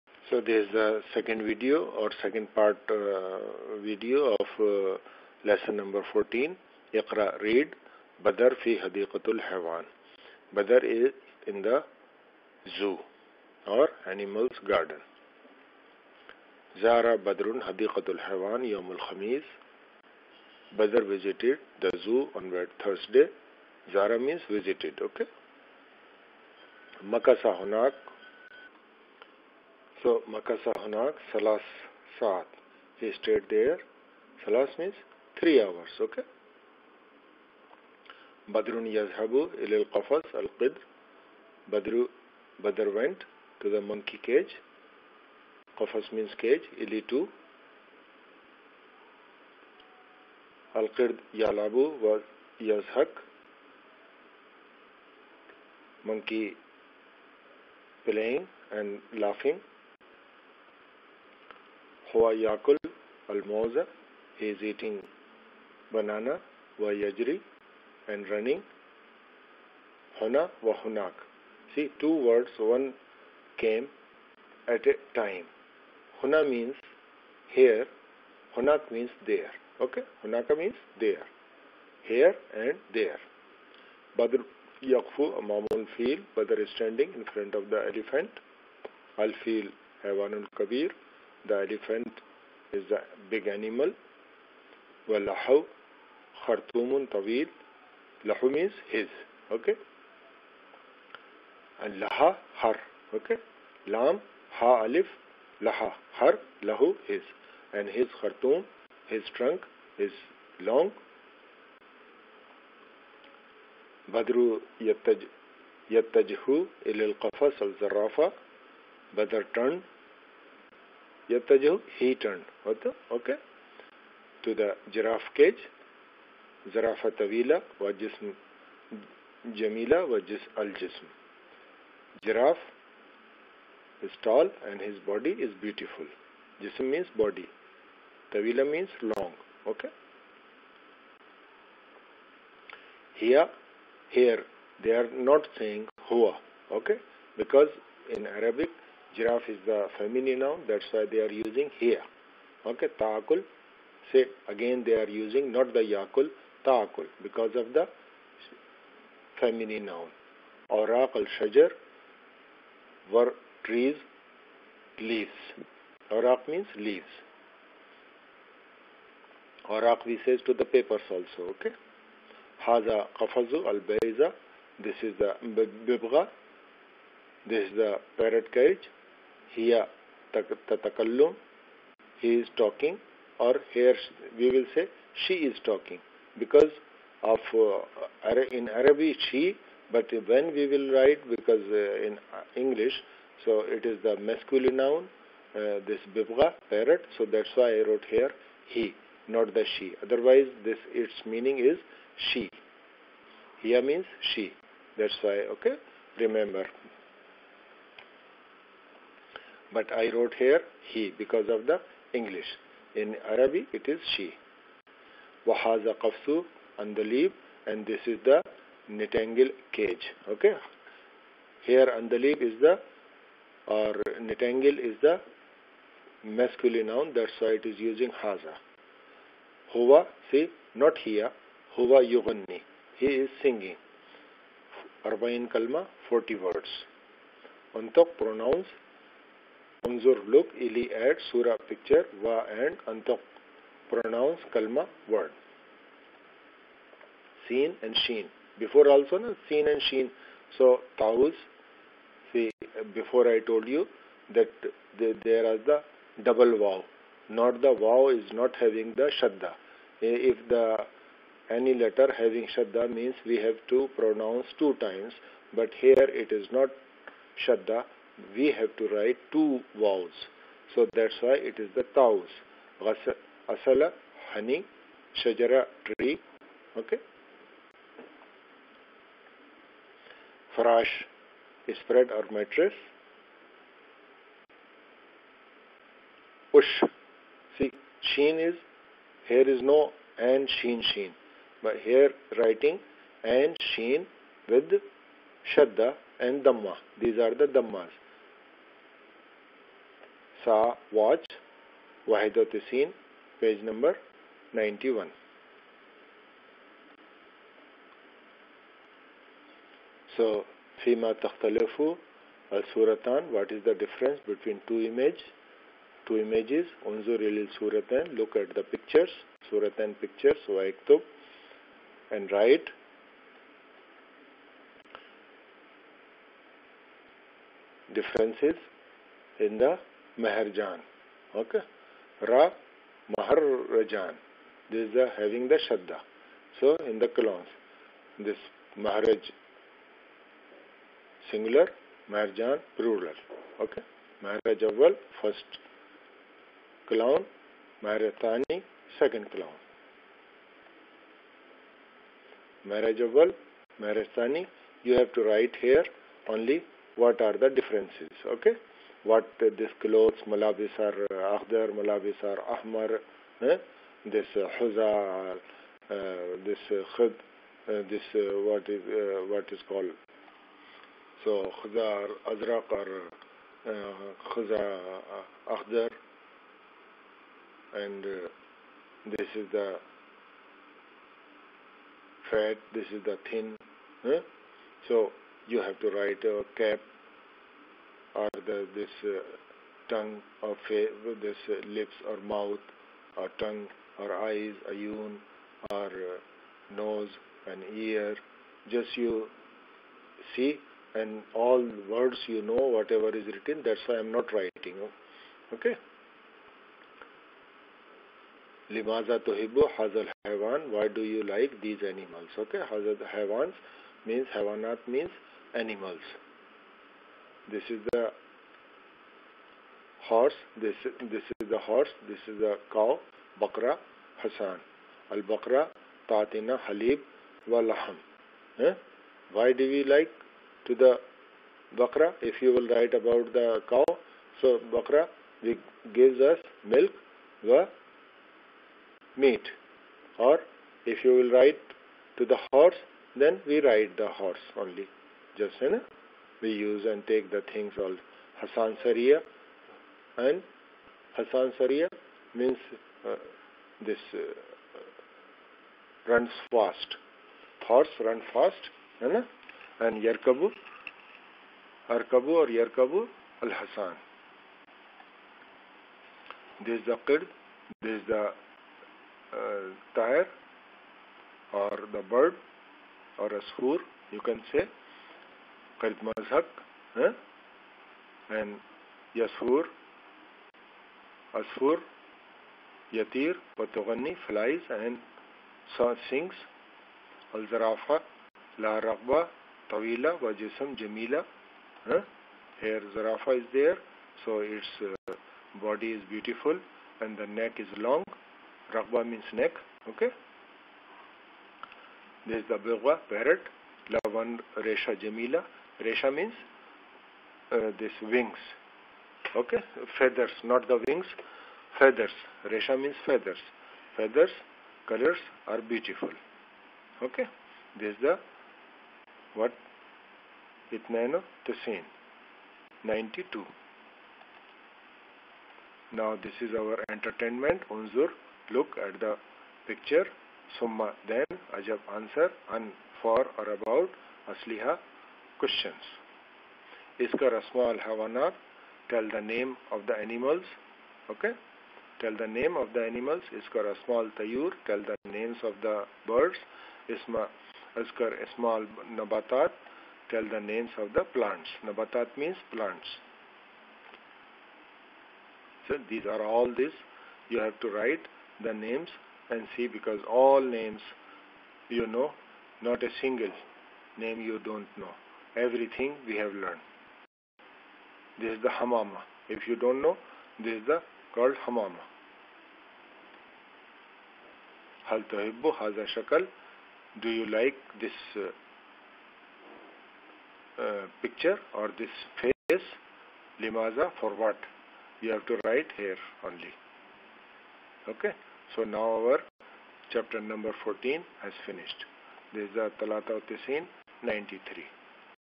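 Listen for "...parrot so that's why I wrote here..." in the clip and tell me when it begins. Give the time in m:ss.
3:16.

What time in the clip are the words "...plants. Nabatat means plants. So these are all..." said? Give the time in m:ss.
9:11.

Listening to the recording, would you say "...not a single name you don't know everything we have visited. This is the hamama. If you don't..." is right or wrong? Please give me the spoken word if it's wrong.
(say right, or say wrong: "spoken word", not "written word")
wrong: "learned", not "visited".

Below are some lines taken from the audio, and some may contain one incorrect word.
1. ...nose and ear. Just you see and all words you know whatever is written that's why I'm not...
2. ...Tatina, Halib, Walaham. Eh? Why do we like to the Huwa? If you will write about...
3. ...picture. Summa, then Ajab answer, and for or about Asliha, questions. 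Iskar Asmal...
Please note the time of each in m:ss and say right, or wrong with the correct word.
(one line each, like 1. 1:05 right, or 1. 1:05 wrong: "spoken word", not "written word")
1. 6:36 right
2. 7:06 wrong: "Bakra", not "Huwa"
3. 8:49 right.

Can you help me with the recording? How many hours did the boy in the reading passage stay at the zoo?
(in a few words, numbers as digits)
3.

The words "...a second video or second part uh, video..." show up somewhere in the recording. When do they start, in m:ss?
0:00.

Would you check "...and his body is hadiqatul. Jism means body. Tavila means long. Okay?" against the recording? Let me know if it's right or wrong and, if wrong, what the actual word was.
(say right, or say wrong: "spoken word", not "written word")
wrong: "beautiful", not "hadiqatul".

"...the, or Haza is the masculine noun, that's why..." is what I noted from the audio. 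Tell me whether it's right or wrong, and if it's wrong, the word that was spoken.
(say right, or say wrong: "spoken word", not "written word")
wrong: "Nitangle", not "Haza".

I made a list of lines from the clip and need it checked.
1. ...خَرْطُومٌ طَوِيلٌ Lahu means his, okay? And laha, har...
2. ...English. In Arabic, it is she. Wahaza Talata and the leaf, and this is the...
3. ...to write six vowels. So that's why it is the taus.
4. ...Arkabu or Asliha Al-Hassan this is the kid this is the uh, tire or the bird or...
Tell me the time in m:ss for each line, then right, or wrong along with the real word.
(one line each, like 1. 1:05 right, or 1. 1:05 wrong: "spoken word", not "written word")
1. 1:36 right
2. 3:32 wrong: "Qafsu", not "Talata"
3. 4:28 wrong: "two", not "six"
4. 7:41 wrong: "Yerkabu", not "Asliha".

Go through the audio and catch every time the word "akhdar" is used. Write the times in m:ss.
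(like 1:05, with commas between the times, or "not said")
6:01, 6:15.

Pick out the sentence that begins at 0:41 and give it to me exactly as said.
Badru Badr went to the monkey cage.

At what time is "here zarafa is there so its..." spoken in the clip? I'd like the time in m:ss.
8:12.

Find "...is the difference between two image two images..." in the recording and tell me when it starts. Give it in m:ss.
5:13.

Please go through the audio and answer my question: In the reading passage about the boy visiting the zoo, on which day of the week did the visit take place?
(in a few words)
Thursday.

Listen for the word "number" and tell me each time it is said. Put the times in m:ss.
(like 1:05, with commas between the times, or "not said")
0:05, 9:50.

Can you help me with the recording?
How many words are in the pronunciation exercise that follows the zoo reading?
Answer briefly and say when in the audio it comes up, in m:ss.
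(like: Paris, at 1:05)
40, at 3:56.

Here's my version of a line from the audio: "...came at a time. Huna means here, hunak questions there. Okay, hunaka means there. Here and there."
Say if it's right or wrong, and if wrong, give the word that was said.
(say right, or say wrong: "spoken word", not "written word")
wrong: "means", not "questions".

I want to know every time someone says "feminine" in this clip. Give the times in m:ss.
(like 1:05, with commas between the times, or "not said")
2:29, 2:39.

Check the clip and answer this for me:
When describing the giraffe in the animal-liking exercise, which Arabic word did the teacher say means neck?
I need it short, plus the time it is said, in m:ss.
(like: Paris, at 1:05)
ragba, at 8:18.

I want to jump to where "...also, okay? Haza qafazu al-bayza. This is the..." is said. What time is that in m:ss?
2:51.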